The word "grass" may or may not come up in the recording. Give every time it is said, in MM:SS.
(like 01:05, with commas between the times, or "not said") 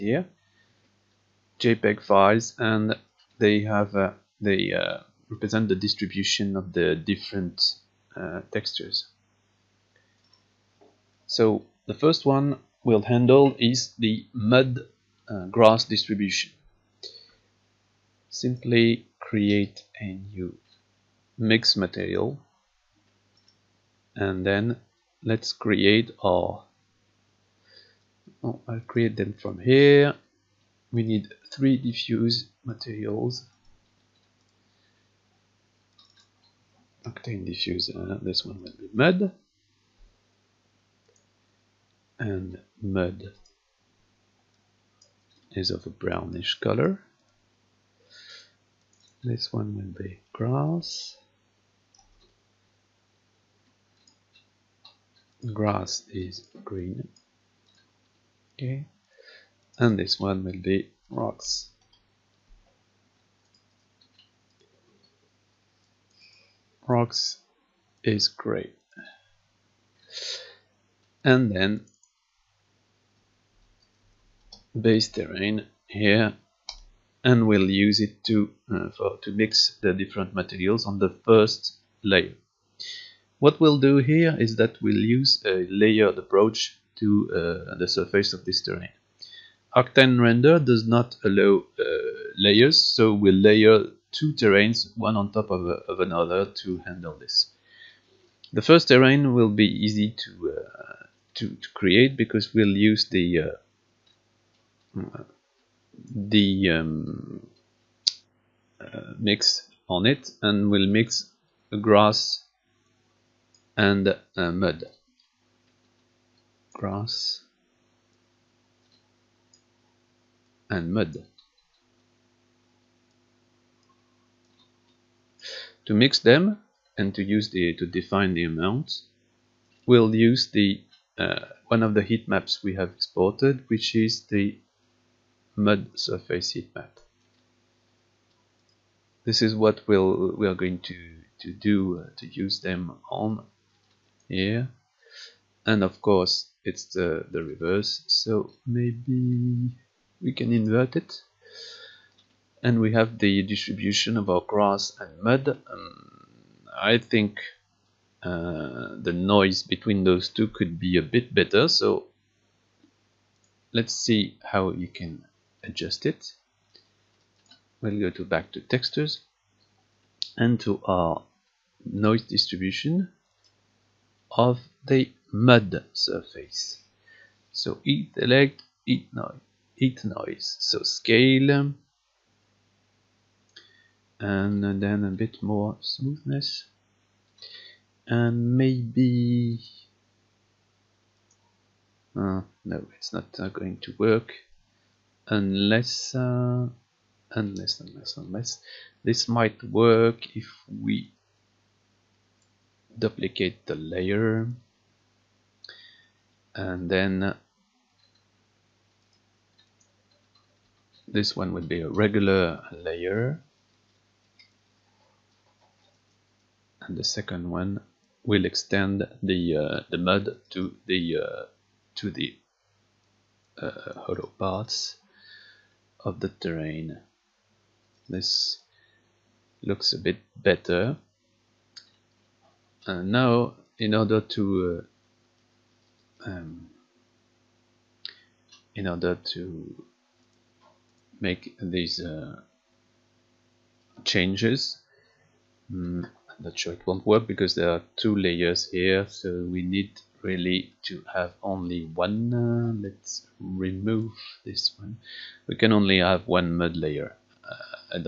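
00:15, 00:50, 00:55, 01:51, 01:56, 02:34.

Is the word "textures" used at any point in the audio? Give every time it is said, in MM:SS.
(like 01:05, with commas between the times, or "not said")
00:08, 02:48.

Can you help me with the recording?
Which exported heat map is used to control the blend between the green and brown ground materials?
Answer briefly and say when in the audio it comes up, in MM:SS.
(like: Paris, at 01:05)
Mud surface heat map, at 02:15.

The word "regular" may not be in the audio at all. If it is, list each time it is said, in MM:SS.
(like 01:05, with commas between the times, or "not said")
03:31.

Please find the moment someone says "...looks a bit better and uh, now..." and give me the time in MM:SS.
03:49.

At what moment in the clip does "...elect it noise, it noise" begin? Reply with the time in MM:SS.
02:58.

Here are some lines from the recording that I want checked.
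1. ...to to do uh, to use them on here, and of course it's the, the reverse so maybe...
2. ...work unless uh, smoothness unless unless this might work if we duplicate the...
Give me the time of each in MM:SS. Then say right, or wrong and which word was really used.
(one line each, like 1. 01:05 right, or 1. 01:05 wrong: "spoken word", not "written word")
1. 02:20 right
2. 03:13 wrong: "unless", not "smoothness".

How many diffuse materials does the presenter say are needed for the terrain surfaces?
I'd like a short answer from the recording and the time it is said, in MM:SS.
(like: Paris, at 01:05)
3, at 00:31.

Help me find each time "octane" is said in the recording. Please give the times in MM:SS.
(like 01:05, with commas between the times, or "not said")
00:37, 01:29.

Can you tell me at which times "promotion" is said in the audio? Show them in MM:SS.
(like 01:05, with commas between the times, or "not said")
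not said.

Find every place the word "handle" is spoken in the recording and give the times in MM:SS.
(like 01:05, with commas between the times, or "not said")
00:13, 01:36.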